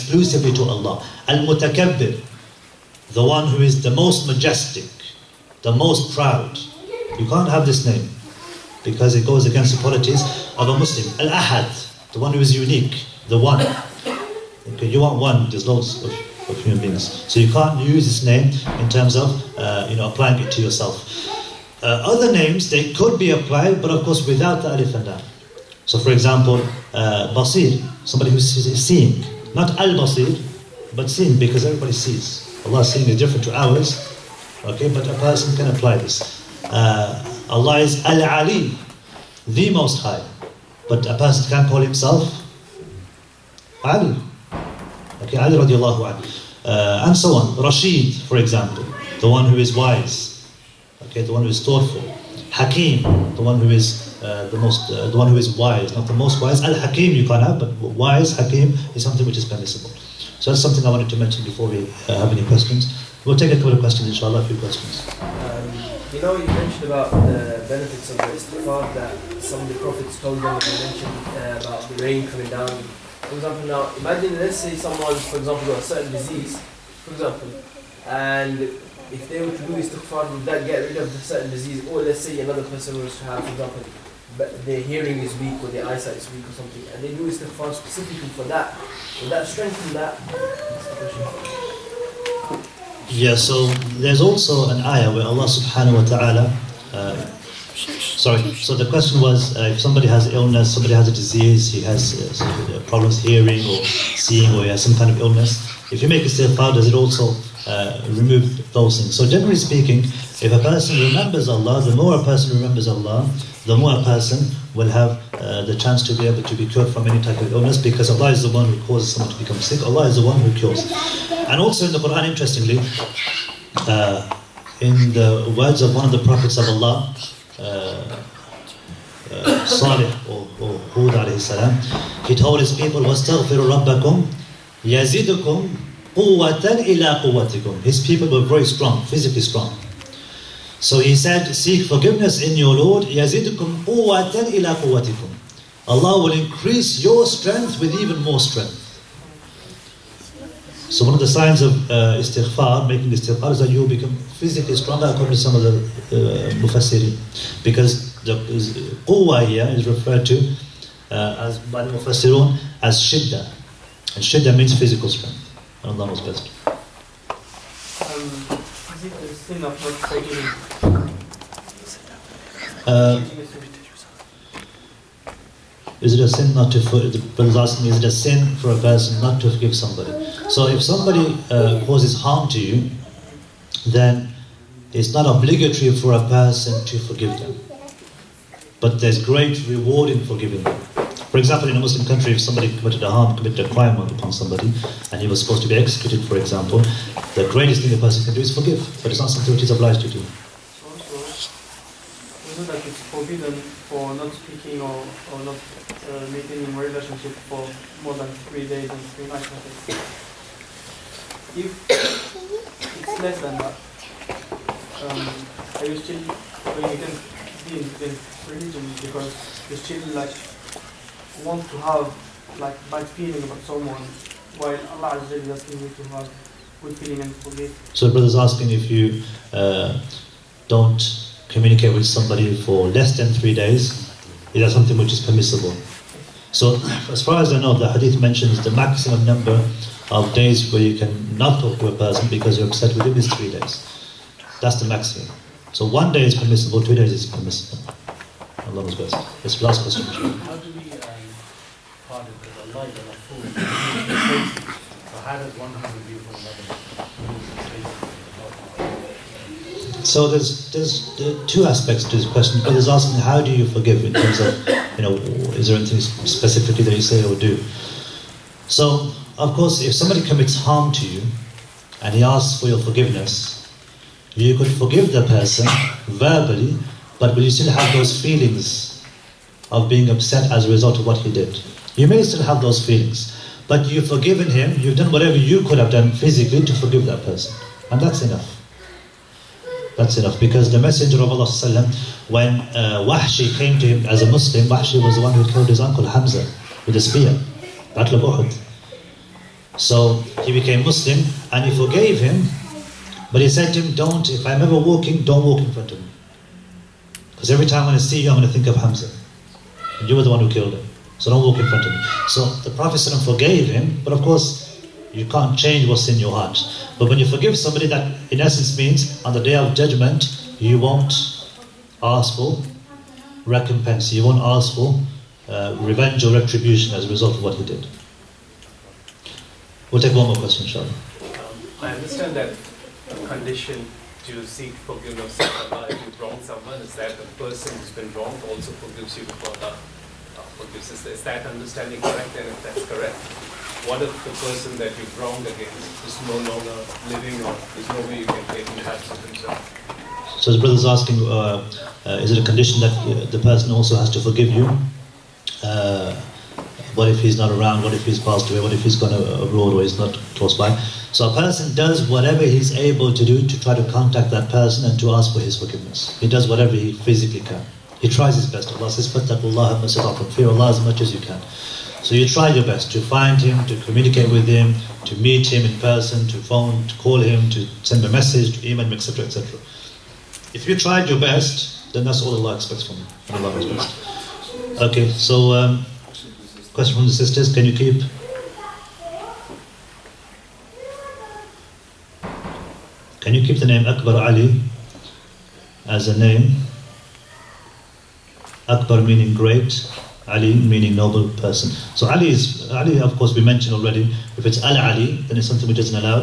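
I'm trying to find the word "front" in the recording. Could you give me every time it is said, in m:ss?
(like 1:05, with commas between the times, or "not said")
5:05, 5:11.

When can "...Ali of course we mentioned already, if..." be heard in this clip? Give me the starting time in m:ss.
6:42.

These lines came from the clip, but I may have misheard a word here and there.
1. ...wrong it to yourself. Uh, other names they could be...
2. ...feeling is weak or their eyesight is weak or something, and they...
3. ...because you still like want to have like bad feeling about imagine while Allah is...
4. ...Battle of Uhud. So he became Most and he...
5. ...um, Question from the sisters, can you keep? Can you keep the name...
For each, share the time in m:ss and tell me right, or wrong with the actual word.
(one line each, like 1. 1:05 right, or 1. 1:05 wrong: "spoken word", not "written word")
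1. 0:20 wrong: "applying", not "wrong"
2. 1:24 wrong: "hearing", not "feeling"
3. 3:39 wrong: "someone", not "imagine"
4. 4:57 wrong: "Muslim", not "Most"
5. 6:25 right.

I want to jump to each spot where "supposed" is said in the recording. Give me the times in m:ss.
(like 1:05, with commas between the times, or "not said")
3:15.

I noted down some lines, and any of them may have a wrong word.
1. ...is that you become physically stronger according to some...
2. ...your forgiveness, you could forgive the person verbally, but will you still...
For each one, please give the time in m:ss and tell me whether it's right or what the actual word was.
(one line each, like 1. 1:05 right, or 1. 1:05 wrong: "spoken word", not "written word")
1. 2:33 right
2. 4:32 right.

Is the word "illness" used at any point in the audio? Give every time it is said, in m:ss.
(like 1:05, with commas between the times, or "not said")
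1:40, 1:45, 1:57.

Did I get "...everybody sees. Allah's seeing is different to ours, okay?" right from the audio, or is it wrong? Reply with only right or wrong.
right.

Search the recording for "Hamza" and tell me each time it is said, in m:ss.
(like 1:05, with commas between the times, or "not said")
4:56, 5:08.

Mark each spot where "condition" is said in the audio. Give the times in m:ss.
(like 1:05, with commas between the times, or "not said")
5:33, 5:52.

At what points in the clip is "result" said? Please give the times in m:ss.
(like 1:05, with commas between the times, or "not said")
4:40, 5:27.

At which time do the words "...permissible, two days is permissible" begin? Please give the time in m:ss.
4:06.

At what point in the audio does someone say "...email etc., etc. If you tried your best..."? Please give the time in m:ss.
6:18.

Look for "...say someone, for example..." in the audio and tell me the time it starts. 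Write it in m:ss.
1:14.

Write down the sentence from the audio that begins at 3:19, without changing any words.
But it's not something which he's obliged to do.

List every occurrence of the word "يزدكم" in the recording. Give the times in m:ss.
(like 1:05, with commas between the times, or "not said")
2:14, 2:23.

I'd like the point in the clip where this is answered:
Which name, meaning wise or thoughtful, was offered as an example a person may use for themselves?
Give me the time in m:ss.
0:47.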